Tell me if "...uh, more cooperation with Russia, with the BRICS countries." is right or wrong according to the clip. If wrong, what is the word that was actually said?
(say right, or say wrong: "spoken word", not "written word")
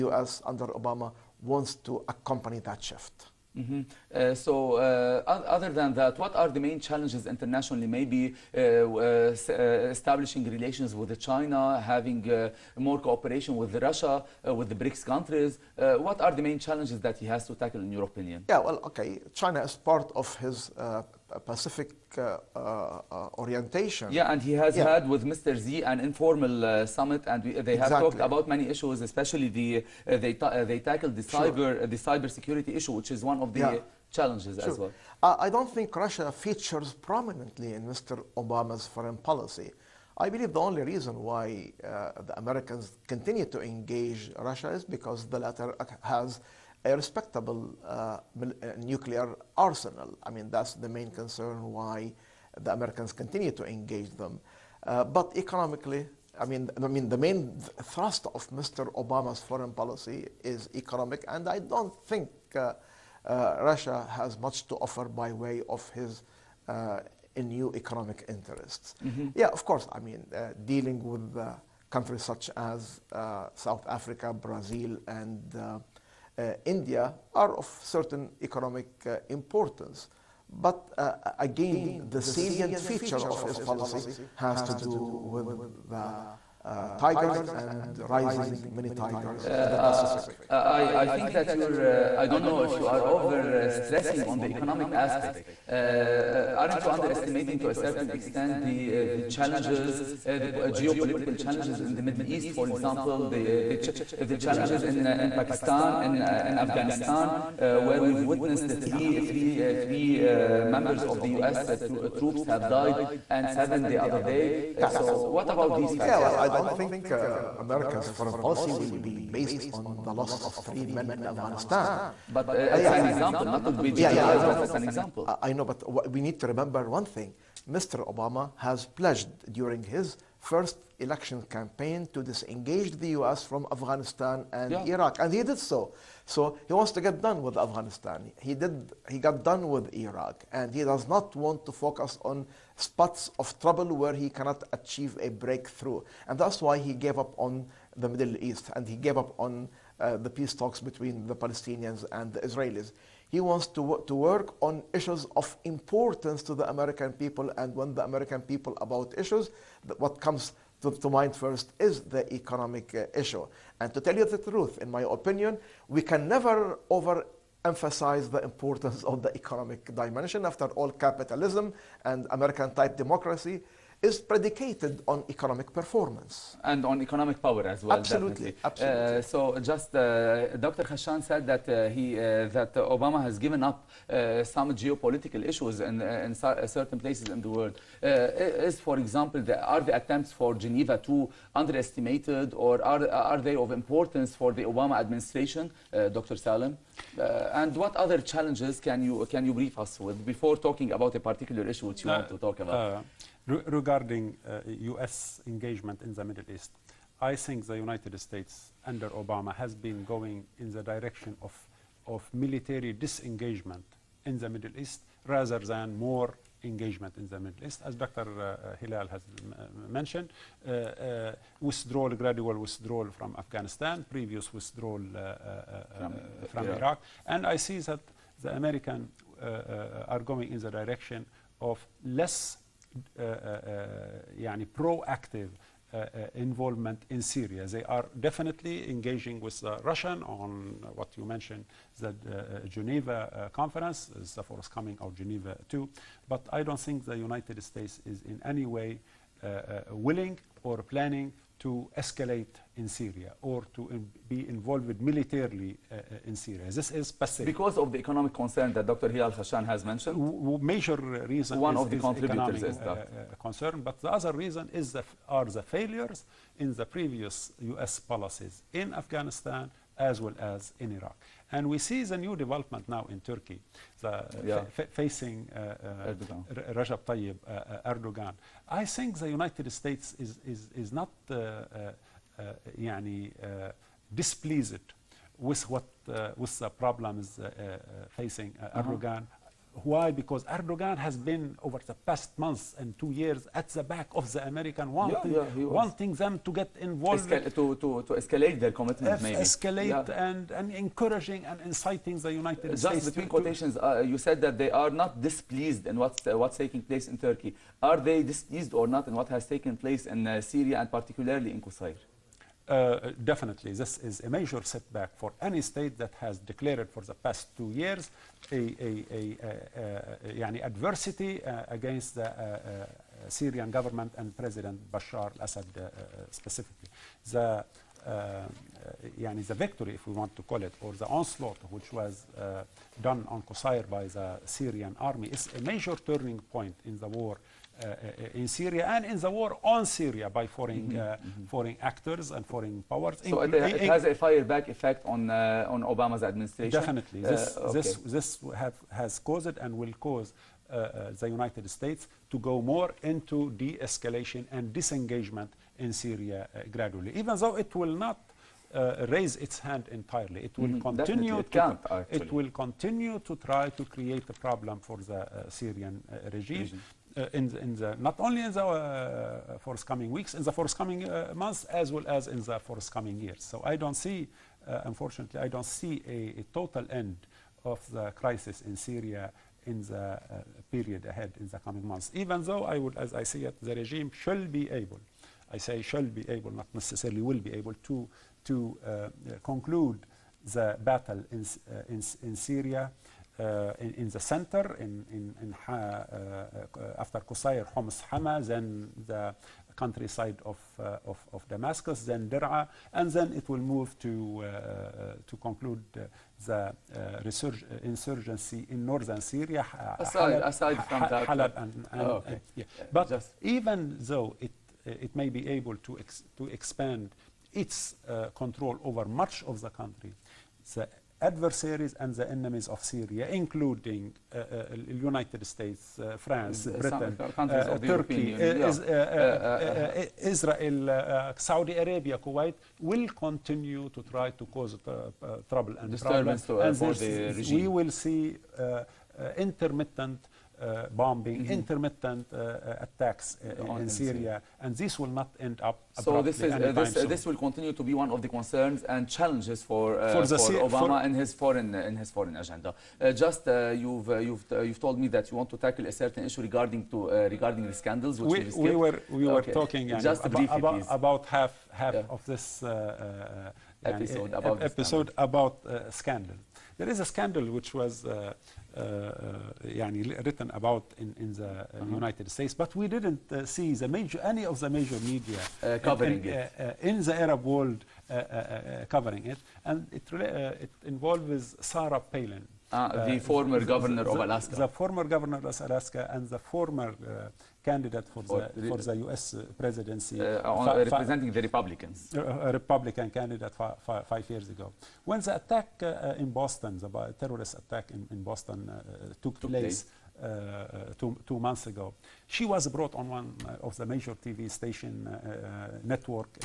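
right.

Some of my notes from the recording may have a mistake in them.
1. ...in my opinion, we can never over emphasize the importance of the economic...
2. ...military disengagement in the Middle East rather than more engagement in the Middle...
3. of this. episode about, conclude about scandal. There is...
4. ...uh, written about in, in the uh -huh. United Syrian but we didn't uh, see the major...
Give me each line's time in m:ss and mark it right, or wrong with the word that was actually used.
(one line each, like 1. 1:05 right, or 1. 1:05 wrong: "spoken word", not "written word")
1. 2:44 right
2. 3:32 right
3. 7:42 wrong: "episode", not "conclude"
4. 7:50 wrong: "States", not "Syrian".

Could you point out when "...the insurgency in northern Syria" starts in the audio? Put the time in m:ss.
6:46.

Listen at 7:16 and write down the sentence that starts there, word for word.
and we will see intermittent uh, bombing, mm -hmm.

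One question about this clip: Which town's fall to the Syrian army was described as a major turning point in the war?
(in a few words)
Qusayr.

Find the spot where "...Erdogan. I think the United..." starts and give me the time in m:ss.
4:37.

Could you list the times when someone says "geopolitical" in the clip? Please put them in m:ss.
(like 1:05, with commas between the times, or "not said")
1:40, 3:04.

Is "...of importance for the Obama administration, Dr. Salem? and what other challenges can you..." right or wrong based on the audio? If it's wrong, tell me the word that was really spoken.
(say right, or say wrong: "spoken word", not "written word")
right.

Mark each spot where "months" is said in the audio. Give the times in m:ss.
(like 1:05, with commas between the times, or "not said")
4:52, 6:11, 6:21, 8:21.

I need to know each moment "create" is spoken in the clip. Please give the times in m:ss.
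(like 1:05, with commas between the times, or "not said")
6:03.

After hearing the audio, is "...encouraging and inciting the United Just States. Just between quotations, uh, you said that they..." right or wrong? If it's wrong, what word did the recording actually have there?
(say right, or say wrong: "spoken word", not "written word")
right.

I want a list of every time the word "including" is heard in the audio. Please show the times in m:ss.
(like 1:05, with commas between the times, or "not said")
7:03.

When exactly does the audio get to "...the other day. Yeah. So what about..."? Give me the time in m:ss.
1:53.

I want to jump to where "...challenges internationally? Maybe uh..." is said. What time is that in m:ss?
0:06.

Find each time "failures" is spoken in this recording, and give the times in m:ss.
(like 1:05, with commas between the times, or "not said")
4:25.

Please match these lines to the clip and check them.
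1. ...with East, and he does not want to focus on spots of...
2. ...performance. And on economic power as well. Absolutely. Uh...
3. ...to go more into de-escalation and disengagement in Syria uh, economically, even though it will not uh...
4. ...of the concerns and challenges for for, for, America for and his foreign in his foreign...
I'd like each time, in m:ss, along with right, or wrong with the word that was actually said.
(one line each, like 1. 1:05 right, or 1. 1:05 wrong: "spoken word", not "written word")
1. 2:19 wrong: "Iraq", not "East"
2. 2:55 right
3. 5:52 wrong: "gradually", not "economically"
4. 7:28 wrong: "Obama", not "America".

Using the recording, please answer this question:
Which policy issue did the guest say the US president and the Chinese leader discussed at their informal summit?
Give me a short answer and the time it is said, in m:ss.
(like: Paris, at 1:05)
Cyber security, at 0:31.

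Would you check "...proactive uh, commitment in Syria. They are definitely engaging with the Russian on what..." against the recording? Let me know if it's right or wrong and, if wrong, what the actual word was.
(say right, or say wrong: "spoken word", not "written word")
wrong: "involvement", not "commitment".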